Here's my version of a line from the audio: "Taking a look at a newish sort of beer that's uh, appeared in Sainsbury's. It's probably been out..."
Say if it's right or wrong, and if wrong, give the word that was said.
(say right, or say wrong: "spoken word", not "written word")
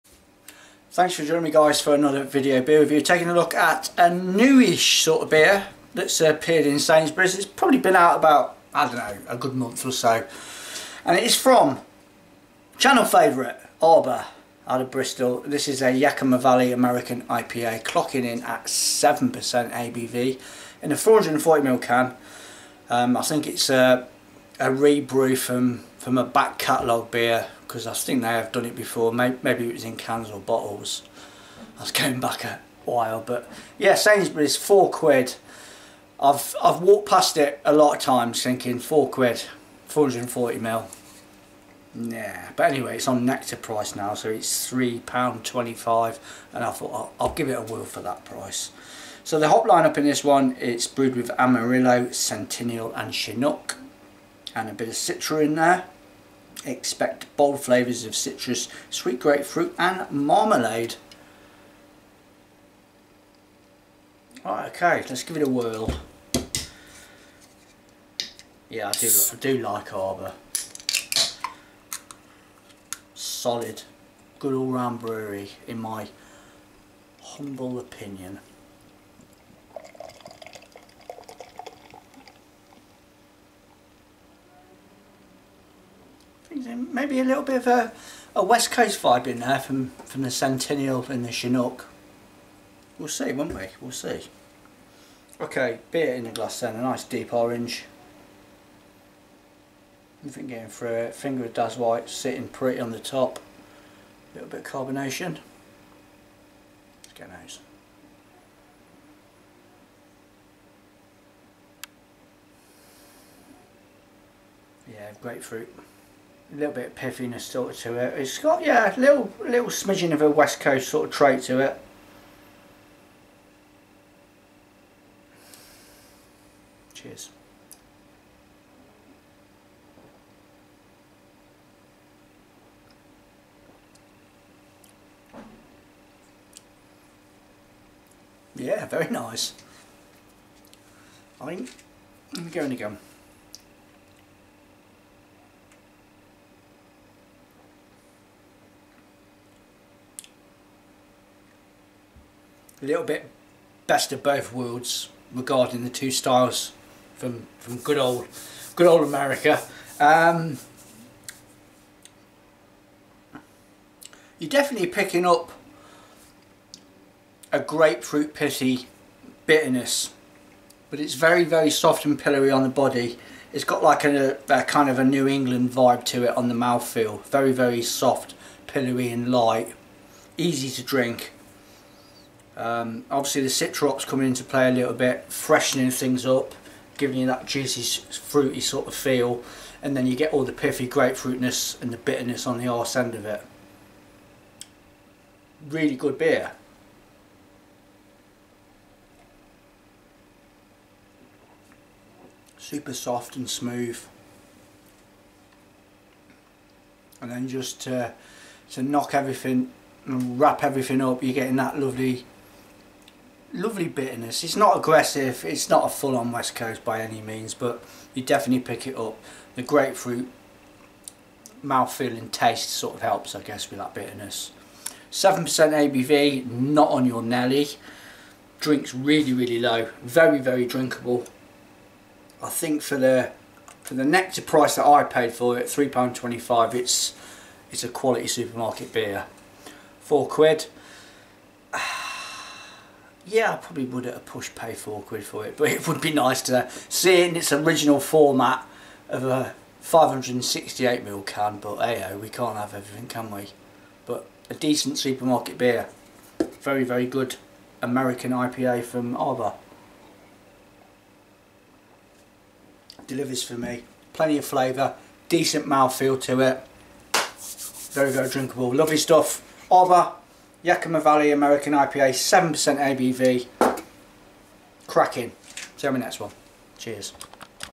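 right.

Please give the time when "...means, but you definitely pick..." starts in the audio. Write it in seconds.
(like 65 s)
217 s.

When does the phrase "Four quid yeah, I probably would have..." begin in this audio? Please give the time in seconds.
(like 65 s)
239 s.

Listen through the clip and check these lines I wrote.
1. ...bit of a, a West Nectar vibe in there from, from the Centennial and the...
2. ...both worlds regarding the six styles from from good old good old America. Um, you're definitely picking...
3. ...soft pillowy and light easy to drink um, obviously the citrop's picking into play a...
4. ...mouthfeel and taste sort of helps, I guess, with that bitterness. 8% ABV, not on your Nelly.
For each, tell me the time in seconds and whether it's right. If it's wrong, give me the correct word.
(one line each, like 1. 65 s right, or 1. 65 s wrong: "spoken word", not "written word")
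1. 87 s wrong: "Coast", not "Nectar"
2. 154 s wrong: "two", not "six"
3. 177 s wrong: "coming", not "picking"
4. 221 s wrong: "7", not "8".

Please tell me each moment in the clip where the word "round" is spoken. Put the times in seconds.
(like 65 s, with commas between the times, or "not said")
74 s.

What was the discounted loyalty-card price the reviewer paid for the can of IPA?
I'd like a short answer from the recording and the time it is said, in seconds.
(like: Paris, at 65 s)
£3.25, at 44 s.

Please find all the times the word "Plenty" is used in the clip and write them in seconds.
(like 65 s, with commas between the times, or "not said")
264 s.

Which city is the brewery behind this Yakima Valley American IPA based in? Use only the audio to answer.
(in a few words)
Bristol.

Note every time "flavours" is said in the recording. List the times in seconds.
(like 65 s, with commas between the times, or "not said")
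57 s, 264 s.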